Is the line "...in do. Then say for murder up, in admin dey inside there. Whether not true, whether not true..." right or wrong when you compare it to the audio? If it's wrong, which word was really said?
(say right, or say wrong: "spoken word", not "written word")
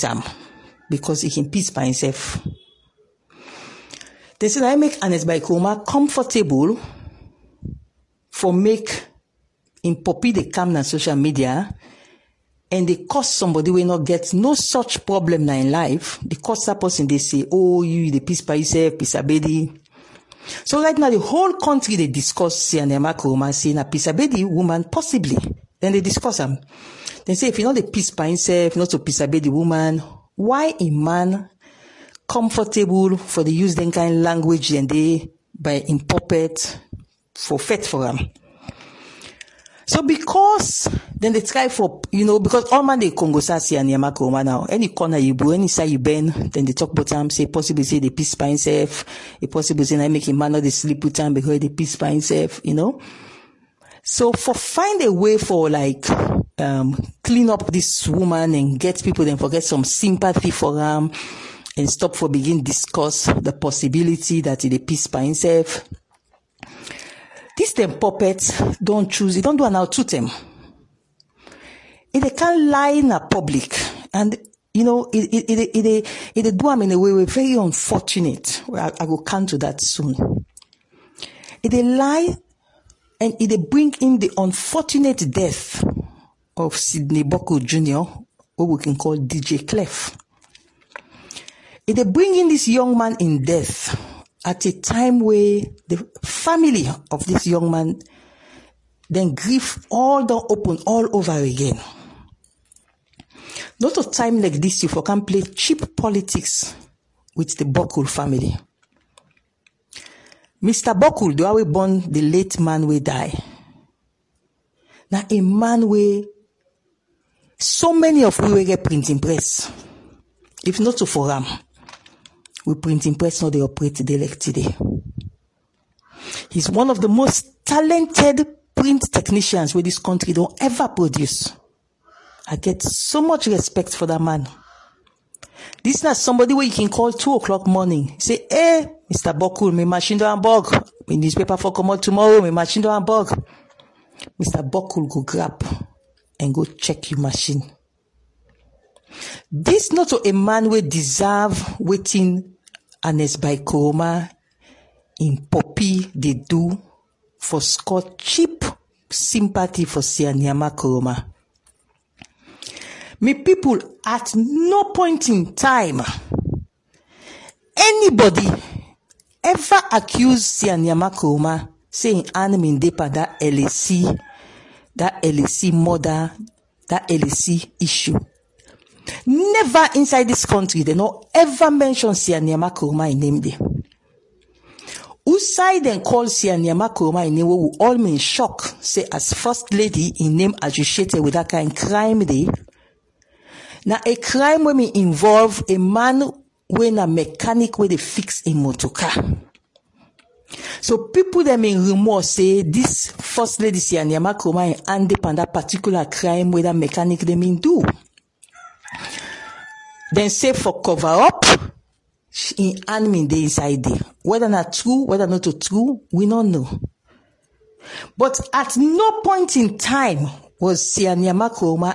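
wrong: "cover", not "murder".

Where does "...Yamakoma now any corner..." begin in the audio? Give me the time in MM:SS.
00:43.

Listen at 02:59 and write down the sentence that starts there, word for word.
Never inside this country, they no ever mention Sia Nyama Koroma in name day.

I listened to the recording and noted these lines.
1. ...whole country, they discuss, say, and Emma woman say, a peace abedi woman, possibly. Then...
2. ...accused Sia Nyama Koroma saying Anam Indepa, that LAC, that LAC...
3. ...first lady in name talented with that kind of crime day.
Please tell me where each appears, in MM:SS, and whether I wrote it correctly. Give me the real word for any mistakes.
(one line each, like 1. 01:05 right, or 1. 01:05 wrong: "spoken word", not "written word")
1. 00:21 right
2. 02:49 right
3. 03:09 wrong: "associated", not "talented".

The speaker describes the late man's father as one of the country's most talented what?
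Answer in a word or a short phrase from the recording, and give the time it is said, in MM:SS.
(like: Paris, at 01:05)
print technicians, at 02:08.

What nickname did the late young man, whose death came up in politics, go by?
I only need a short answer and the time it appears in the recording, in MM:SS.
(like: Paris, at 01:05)
DJ Clef, at 01:29.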